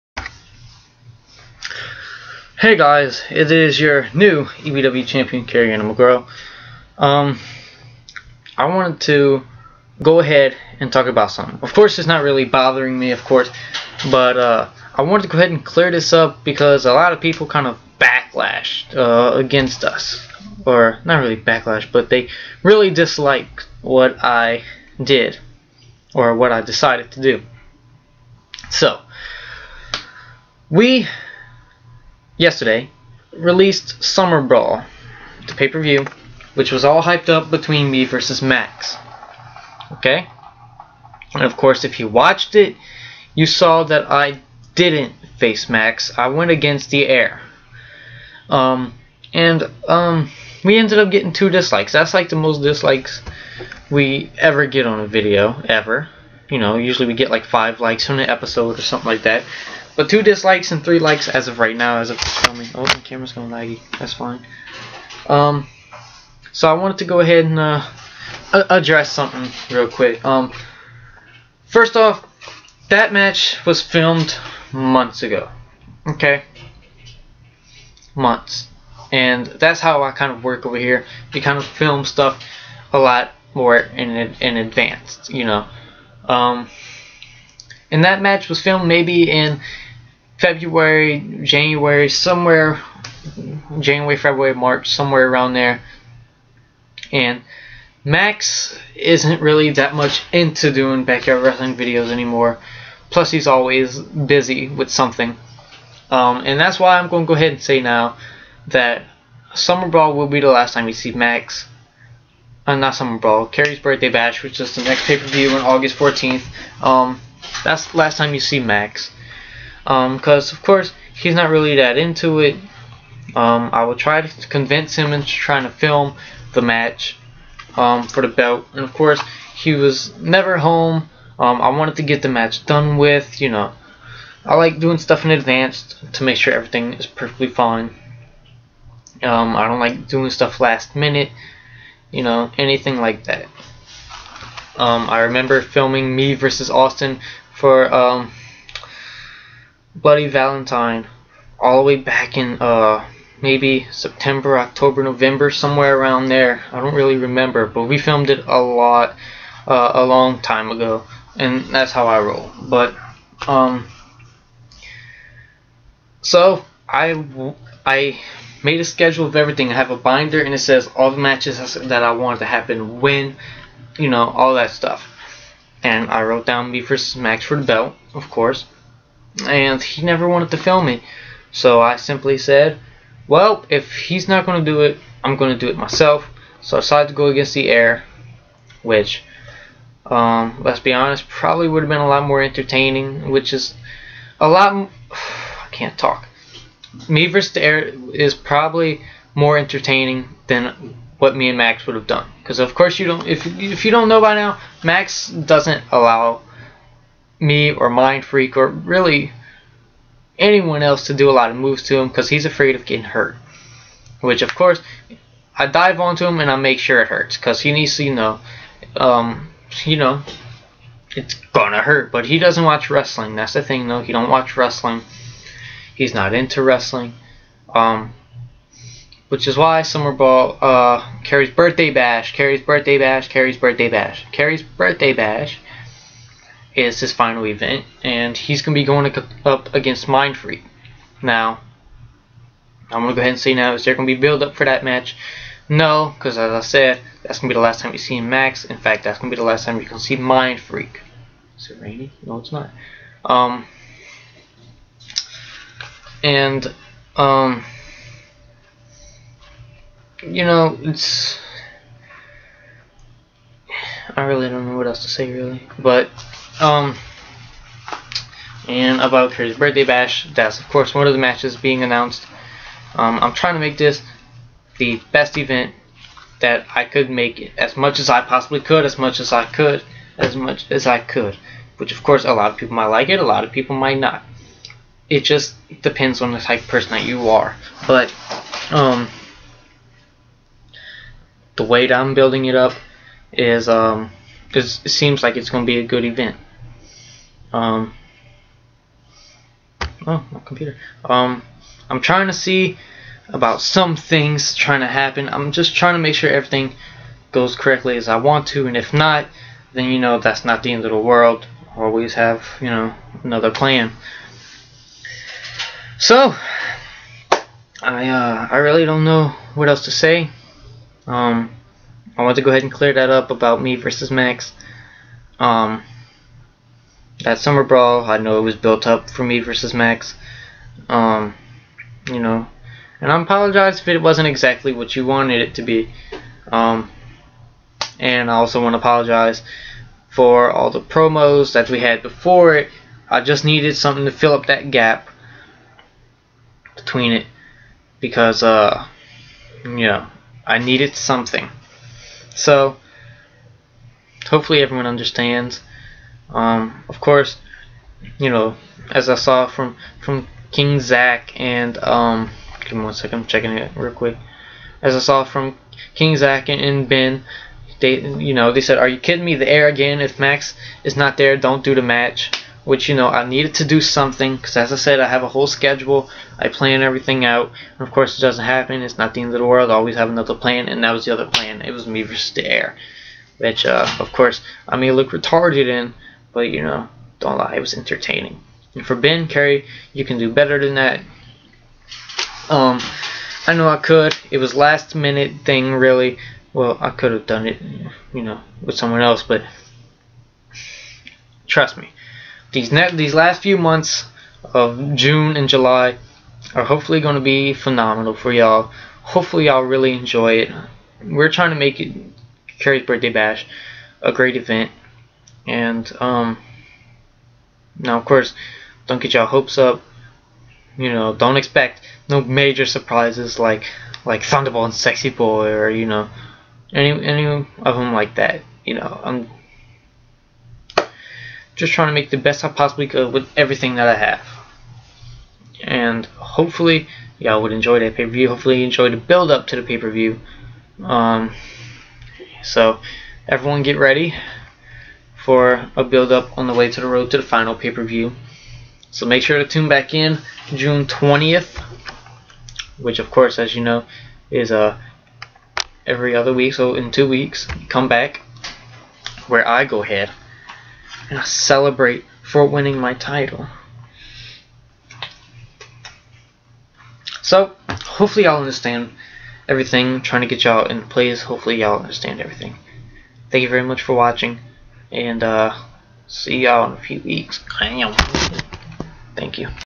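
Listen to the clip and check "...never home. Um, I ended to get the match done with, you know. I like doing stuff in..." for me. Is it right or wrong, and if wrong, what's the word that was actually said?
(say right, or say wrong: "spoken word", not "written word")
wrong: "wanted", not "ended".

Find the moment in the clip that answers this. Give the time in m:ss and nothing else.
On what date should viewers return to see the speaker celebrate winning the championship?
7:30.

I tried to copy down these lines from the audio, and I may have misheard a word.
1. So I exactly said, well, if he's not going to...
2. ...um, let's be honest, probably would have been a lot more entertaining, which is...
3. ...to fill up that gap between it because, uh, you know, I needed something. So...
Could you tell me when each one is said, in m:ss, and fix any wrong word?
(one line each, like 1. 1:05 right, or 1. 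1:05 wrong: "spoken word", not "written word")
1. 3:01 wrong: "simply", not "exactly"
2. 3:10 right
3. 5:44 right.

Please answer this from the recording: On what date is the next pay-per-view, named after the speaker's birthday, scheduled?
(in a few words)
August 14th.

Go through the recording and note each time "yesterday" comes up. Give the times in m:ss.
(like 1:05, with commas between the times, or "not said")
0:32.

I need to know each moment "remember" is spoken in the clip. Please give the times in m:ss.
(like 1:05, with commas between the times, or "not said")
2:25, 2:37.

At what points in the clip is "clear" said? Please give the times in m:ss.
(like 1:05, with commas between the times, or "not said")
0:15, 5:22.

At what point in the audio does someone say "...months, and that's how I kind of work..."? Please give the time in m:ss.
1:18.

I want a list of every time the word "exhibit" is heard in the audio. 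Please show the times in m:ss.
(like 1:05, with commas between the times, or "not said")
not said.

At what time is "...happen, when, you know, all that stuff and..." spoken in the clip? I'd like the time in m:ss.
2:52.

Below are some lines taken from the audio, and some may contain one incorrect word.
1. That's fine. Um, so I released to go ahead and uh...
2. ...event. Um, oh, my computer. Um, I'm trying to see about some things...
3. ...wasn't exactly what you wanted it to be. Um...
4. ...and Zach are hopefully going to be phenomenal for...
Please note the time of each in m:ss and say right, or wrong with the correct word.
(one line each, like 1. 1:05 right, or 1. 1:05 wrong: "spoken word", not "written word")
1. 1:03 wrong: "wanted", not "released"
2. 4:56 right
3. 5:34 right
4. 6:45 wrong: "July", not "Zach".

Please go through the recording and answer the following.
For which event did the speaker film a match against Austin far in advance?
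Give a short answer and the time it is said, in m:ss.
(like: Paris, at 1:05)
Bloody Valentine, at 2:29.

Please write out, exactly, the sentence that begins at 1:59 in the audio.
Um, cause of course he's not really that into it.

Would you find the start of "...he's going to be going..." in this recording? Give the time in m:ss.
3:58.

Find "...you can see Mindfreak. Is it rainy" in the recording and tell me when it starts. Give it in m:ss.
4:09.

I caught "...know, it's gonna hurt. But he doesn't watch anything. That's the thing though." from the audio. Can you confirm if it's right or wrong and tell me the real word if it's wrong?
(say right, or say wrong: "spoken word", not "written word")
wrong: "wrestling", not "anything".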